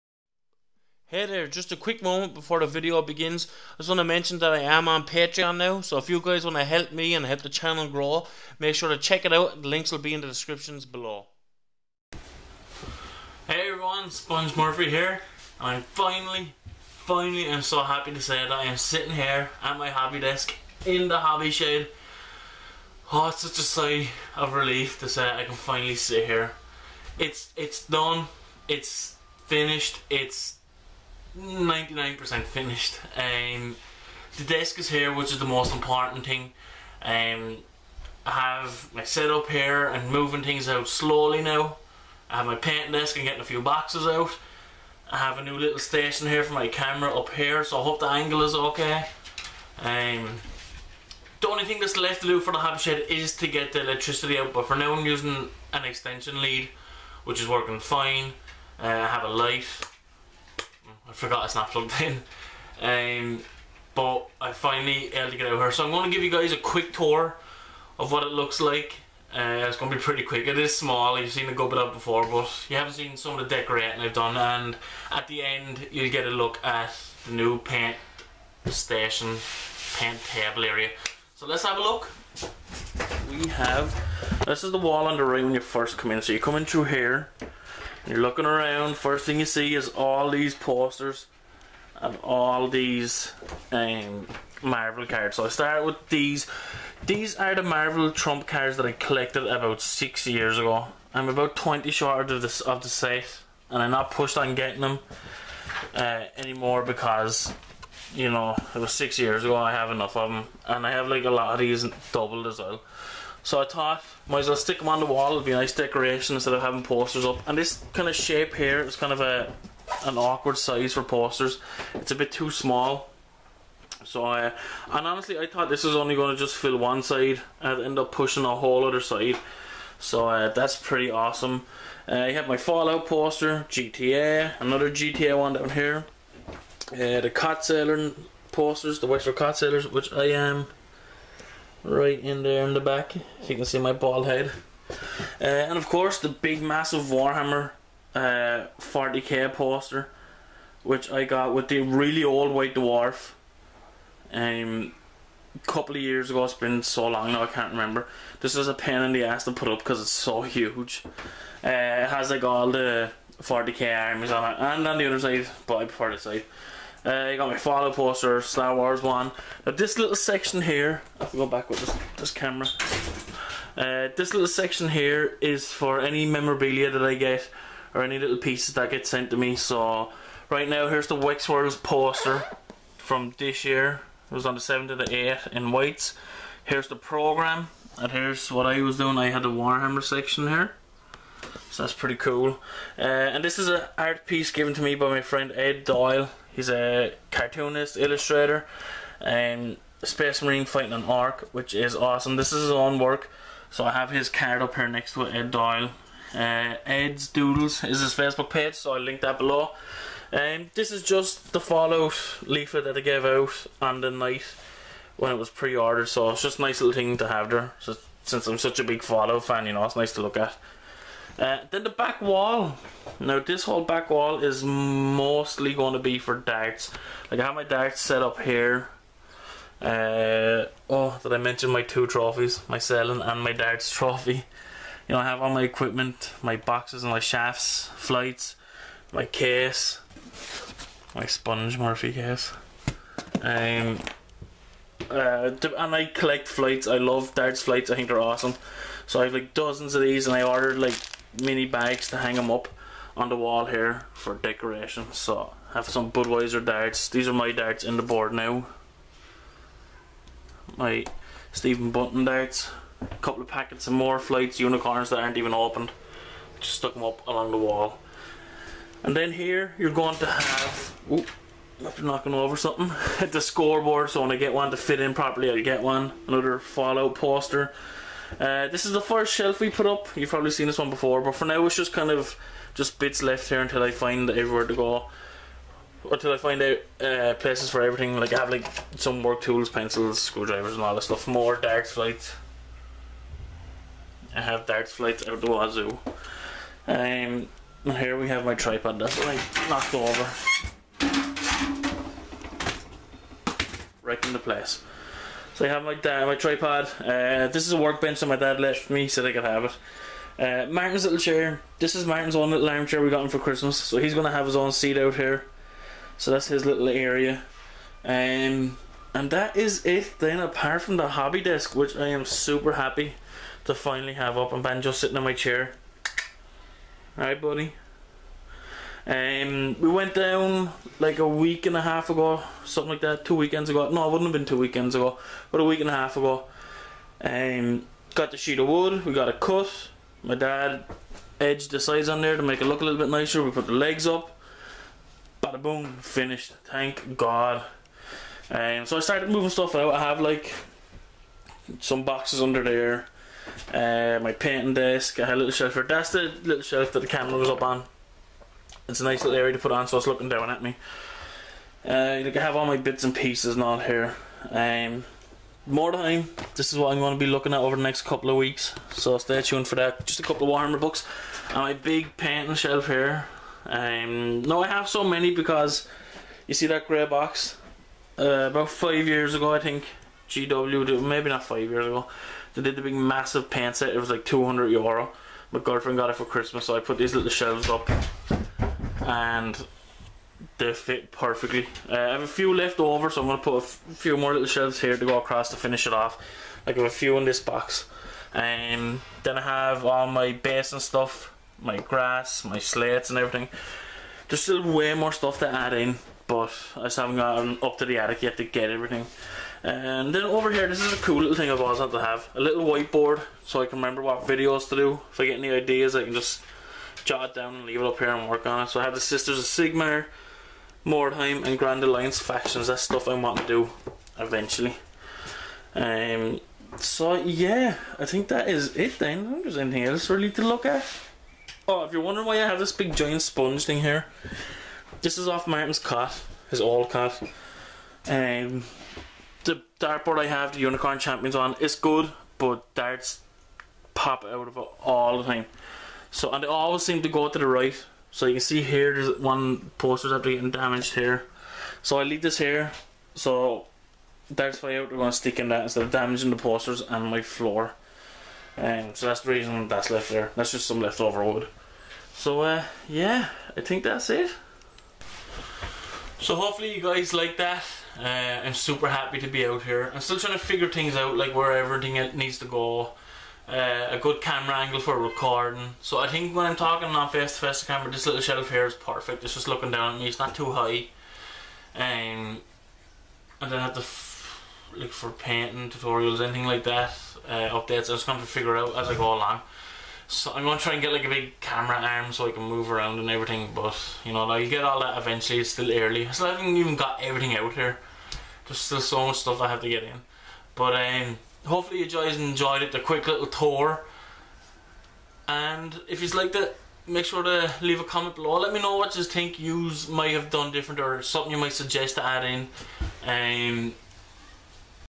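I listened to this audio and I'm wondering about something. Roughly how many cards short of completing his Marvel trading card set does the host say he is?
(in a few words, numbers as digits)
20.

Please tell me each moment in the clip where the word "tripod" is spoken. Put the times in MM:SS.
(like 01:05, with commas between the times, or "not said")
04:58, 05:06.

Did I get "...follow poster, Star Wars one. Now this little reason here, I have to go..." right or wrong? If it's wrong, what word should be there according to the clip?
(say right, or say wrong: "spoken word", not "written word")
wrong: "section", not "reason".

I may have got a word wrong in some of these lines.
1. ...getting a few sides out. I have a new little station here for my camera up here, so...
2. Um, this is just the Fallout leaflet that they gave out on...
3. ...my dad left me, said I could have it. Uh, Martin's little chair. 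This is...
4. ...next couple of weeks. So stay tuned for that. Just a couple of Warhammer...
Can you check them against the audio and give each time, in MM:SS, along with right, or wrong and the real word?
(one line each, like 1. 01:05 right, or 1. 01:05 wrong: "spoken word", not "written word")
1. 00:43 wrong: "boxes", not "sides"
2. 03:30 right
3. 05:08 right
4. 06:07 right.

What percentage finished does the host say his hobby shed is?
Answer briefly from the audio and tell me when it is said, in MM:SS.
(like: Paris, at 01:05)
99%, at 00:31.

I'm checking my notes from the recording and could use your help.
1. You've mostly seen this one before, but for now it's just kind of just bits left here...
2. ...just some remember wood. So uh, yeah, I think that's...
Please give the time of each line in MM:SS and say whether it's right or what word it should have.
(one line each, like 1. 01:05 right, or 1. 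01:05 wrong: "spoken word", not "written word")
1. 04:40 wrong: "probably", not "mostly"
2. 07:40 wrong: "leftover", not "remember".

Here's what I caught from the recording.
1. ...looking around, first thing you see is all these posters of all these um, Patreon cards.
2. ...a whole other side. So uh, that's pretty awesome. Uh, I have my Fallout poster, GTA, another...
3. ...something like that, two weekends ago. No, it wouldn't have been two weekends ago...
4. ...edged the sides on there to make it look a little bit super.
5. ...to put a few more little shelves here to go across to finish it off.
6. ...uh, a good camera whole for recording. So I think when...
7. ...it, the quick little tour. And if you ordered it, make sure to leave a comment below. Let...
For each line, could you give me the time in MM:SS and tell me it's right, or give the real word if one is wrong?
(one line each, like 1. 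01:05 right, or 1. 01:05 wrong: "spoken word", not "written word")
1. 01:28 wrong: "Marvel", not "Patreon"
2. 02:08 right
3. 05:32 right
4. 05:41 wrong: "nicer", not "super"
5. 06:33 right
6. 07:53 wrong: "angle", not "whole"
7. 08:22 wrong: "liked", not "ordered".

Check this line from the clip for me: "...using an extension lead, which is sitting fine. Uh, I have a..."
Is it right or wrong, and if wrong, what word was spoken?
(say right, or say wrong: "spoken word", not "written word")
wrong: "working", not "sitting".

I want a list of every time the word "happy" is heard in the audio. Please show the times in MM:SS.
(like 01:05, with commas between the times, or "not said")
00:17, 05:22, 07:48.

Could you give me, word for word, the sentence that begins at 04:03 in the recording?
Um, uh, and I collect flights.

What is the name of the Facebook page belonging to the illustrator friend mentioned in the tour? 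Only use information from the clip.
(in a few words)
Ed's Doodles.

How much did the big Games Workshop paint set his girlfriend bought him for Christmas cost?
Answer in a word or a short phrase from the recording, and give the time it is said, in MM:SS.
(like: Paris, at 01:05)
200 euro, at 06:24.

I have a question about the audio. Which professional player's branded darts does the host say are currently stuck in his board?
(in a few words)
Stephen Bunting.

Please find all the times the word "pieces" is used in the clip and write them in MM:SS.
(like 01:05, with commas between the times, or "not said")
02:58, 03:14, 06:03.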